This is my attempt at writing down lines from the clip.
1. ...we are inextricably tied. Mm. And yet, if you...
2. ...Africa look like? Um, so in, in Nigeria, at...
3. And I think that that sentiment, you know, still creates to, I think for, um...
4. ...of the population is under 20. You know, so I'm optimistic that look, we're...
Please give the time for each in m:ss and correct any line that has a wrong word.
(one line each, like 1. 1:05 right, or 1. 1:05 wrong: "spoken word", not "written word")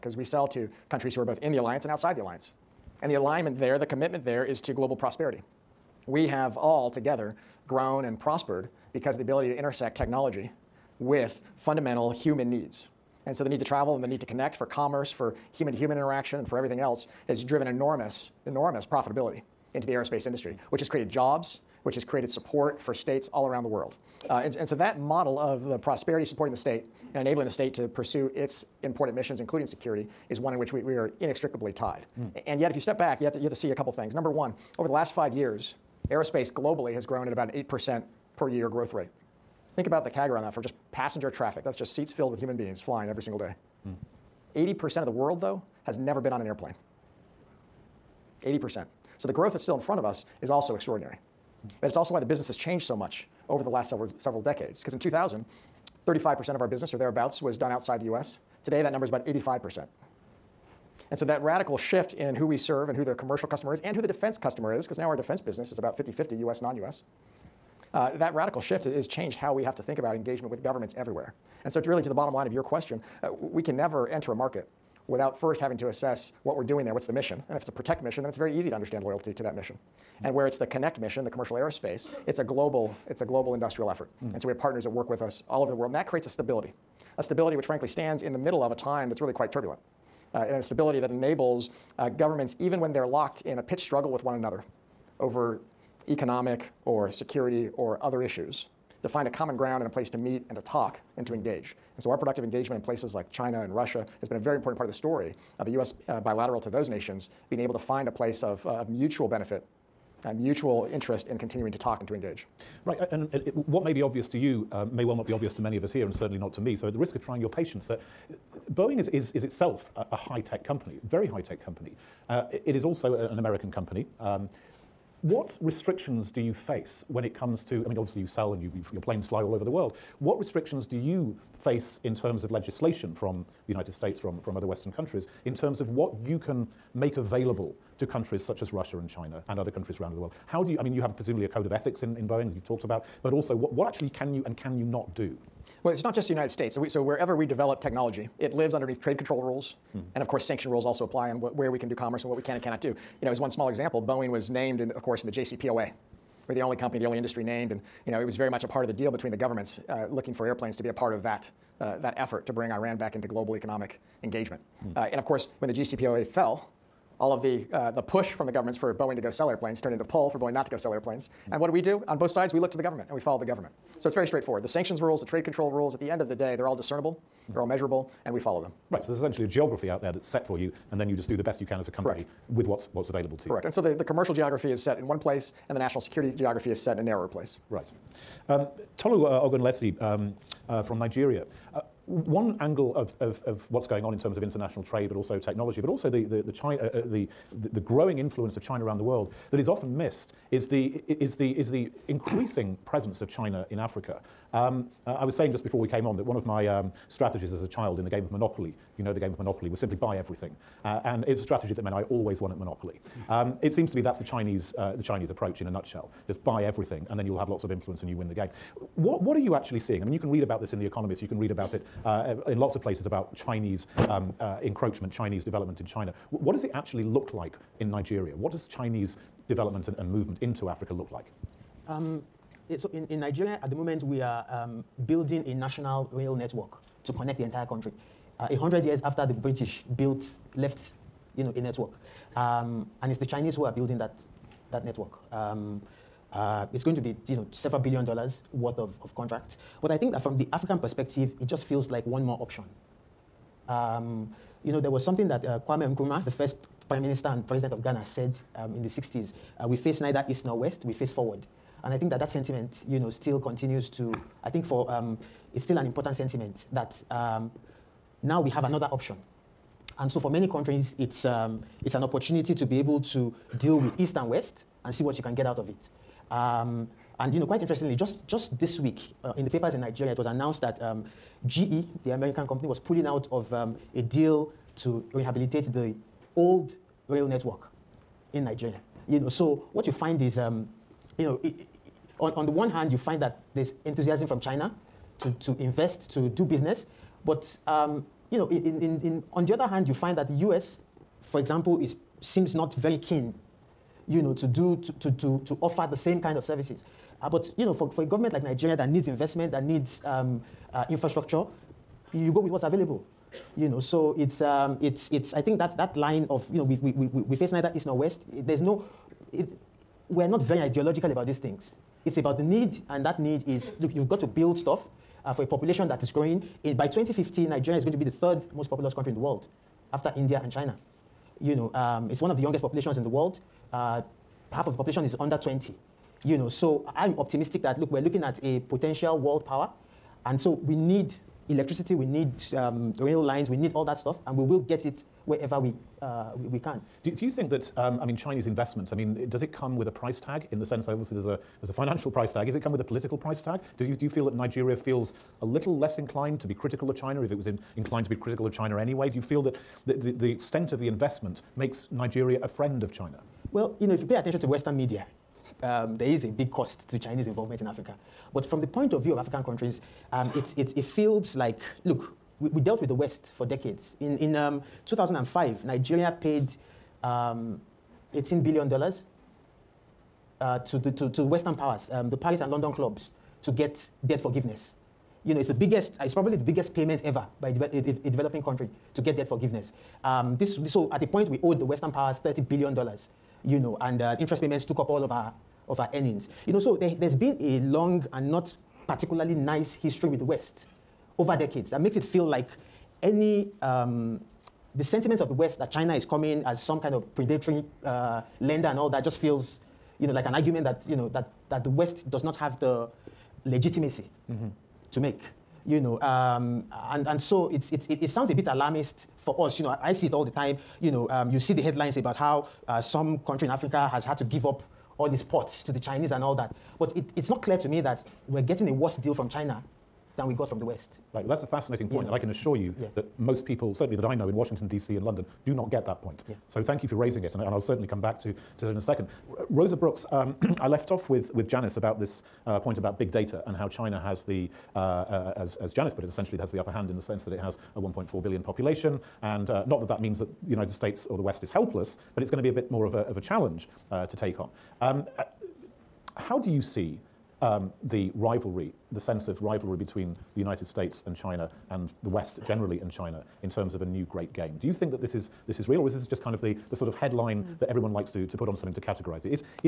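1. 0:30 right
2. 3:50 right
3. 4:21 wrong: "continues", not "creates"
4. 5:34 right.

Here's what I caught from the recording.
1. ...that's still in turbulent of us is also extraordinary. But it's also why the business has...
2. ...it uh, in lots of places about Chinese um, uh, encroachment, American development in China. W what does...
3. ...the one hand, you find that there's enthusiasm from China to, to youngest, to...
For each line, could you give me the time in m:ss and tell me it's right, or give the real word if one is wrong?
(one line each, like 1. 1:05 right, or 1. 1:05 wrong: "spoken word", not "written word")
1. 0:49 wrong: "front", not "turbulent"
2. 3:41 wrong: "Chinese", not "American"
3. 4:52 wrong: "invest", not "youngest".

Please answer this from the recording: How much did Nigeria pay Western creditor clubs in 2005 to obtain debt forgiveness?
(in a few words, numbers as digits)
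$18 billion.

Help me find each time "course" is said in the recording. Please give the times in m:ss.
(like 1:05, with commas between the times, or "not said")
2:30, 2:35, 2:45.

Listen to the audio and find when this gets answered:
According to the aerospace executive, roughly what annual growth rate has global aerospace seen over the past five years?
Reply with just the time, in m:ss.
0:37.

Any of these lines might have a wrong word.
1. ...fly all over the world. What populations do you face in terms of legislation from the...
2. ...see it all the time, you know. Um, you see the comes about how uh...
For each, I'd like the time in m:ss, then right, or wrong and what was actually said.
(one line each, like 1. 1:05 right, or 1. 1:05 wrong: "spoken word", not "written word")
1. 2:09 wrong: "restrictions", not "populations"
2. 6:59 wrong: "headlines", not "comes".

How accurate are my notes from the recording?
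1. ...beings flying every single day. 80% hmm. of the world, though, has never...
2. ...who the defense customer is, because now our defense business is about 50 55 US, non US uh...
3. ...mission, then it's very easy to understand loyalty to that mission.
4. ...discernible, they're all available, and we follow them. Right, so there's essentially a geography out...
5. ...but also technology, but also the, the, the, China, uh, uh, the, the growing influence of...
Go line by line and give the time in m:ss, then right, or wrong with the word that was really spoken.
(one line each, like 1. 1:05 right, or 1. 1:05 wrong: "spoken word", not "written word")
1. 0:42 right
2. 1:03 wrong: "50", not "55"
3. 1:18 right
4. 2:56 wrong: "measurable", not "available"
5. 3:15 right.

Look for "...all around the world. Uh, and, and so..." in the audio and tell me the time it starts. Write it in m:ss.
0:23.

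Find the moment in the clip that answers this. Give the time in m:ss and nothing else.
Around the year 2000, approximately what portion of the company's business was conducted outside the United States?
0:56.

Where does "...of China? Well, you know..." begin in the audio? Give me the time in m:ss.
6:02.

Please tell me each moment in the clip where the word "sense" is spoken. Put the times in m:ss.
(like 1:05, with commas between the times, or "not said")
5:50, 7:27, 7:38.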